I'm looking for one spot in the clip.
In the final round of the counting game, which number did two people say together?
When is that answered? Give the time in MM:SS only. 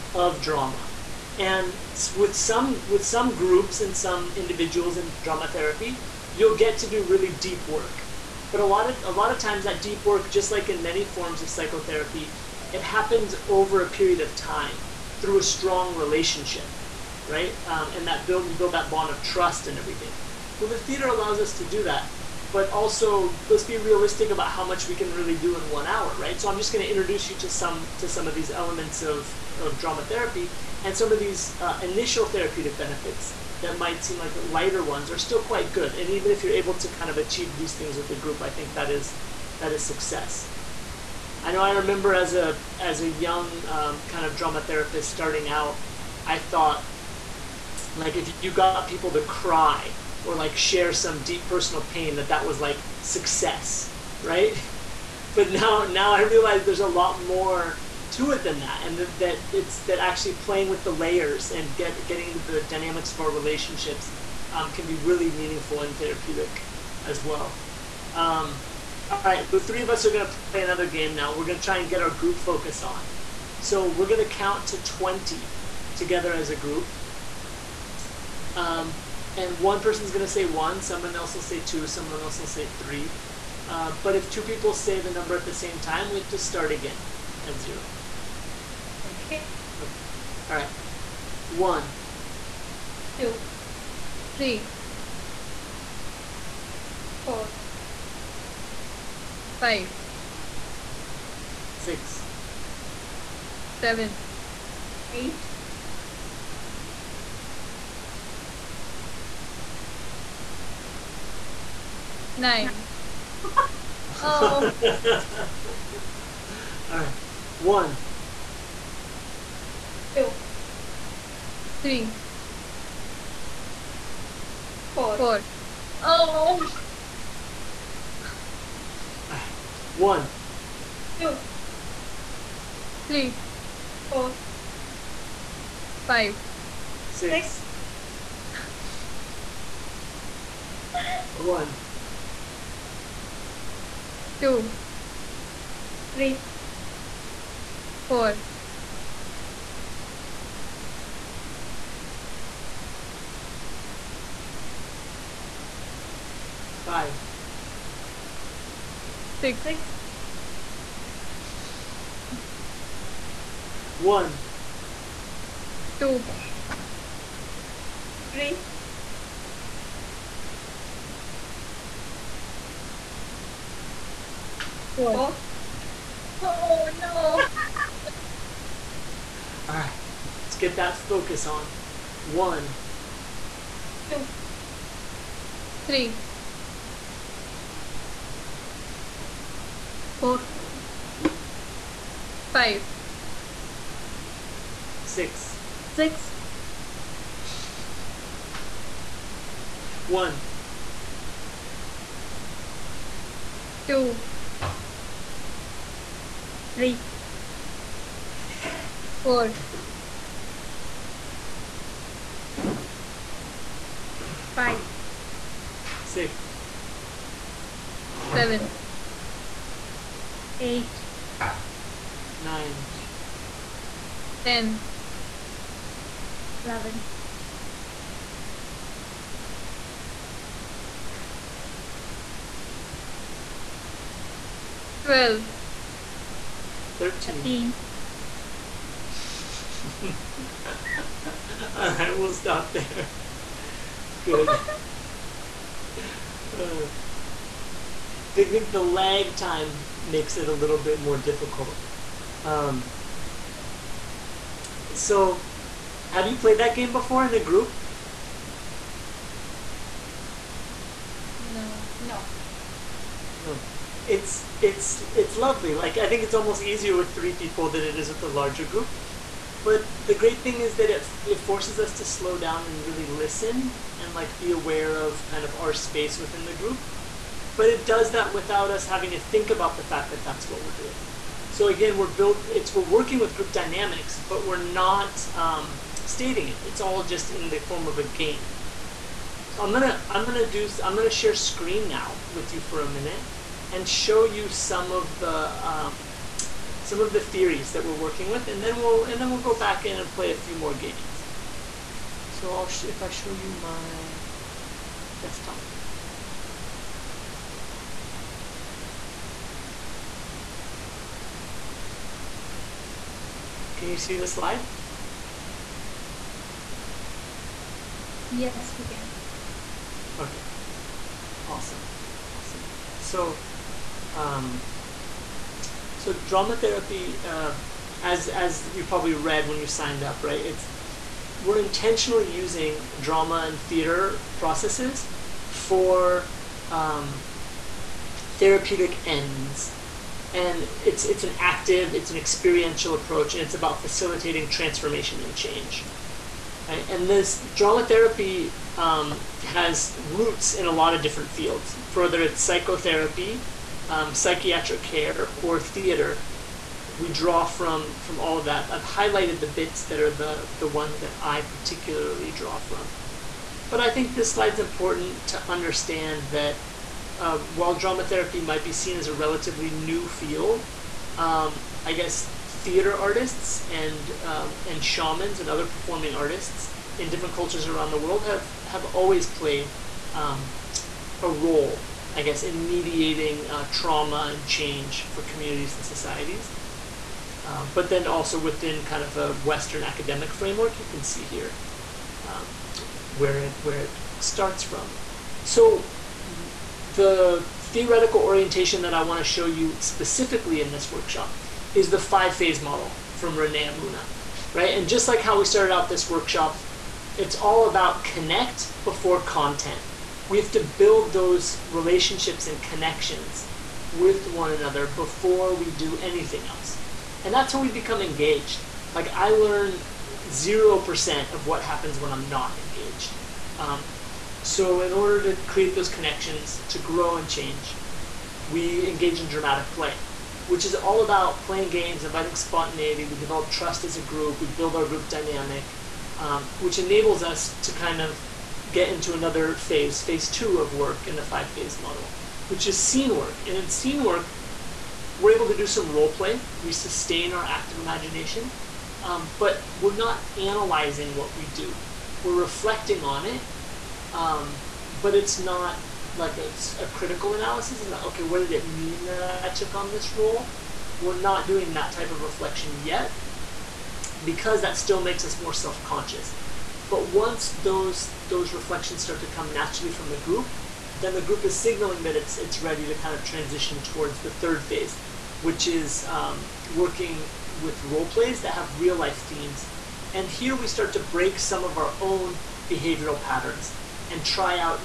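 03:56.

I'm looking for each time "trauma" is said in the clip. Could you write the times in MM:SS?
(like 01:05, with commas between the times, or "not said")
06:23.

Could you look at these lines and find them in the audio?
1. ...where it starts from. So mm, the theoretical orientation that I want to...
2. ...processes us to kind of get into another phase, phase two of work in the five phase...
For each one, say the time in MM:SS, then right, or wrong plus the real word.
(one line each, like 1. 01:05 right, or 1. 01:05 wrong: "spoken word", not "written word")
1. 06:33 right
2. 07:16 wrong: "enables", not "processes".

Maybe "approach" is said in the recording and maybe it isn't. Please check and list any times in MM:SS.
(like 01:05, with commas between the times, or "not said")
05:42.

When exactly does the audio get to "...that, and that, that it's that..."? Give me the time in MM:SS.
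00:58.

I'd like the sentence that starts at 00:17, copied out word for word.
Um, and that build, you build that bond of trust and everything.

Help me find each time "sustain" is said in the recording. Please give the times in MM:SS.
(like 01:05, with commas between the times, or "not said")
07:26.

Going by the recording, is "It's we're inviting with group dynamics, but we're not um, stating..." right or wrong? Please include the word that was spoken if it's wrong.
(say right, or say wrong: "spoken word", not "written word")
wrong: "working", not "inviting".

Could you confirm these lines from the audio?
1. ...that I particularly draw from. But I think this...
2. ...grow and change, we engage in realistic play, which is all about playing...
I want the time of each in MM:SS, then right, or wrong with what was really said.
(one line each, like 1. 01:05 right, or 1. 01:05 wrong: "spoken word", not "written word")
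1. 06:01 right
2. 07:06 wrong: "dramatic", not "realistic".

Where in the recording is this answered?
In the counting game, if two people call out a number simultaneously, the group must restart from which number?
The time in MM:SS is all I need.
01:27.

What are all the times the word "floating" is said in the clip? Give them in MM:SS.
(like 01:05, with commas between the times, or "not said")
not said.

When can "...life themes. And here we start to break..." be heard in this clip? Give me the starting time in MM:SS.
07:58.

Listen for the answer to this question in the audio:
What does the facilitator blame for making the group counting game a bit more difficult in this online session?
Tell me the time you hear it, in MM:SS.
04:08.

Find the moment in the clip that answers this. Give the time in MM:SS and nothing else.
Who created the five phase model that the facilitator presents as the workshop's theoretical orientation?
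06:43.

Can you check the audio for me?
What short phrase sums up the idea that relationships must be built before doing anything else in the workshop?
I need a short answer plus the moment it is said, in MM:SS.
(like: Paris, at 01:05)
Connect before content, at 06:48.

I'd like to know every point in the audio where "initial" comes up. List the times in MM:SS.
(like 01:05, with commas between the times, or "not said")
00:31.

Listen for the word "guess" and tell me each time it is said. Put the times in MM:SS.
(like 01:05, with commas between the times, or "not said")
06:11, 06:22.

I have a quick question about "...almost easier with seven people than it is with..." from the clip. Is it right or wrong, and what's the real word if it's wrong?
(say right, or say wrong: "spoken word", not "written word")
wrong: "three", not "seven".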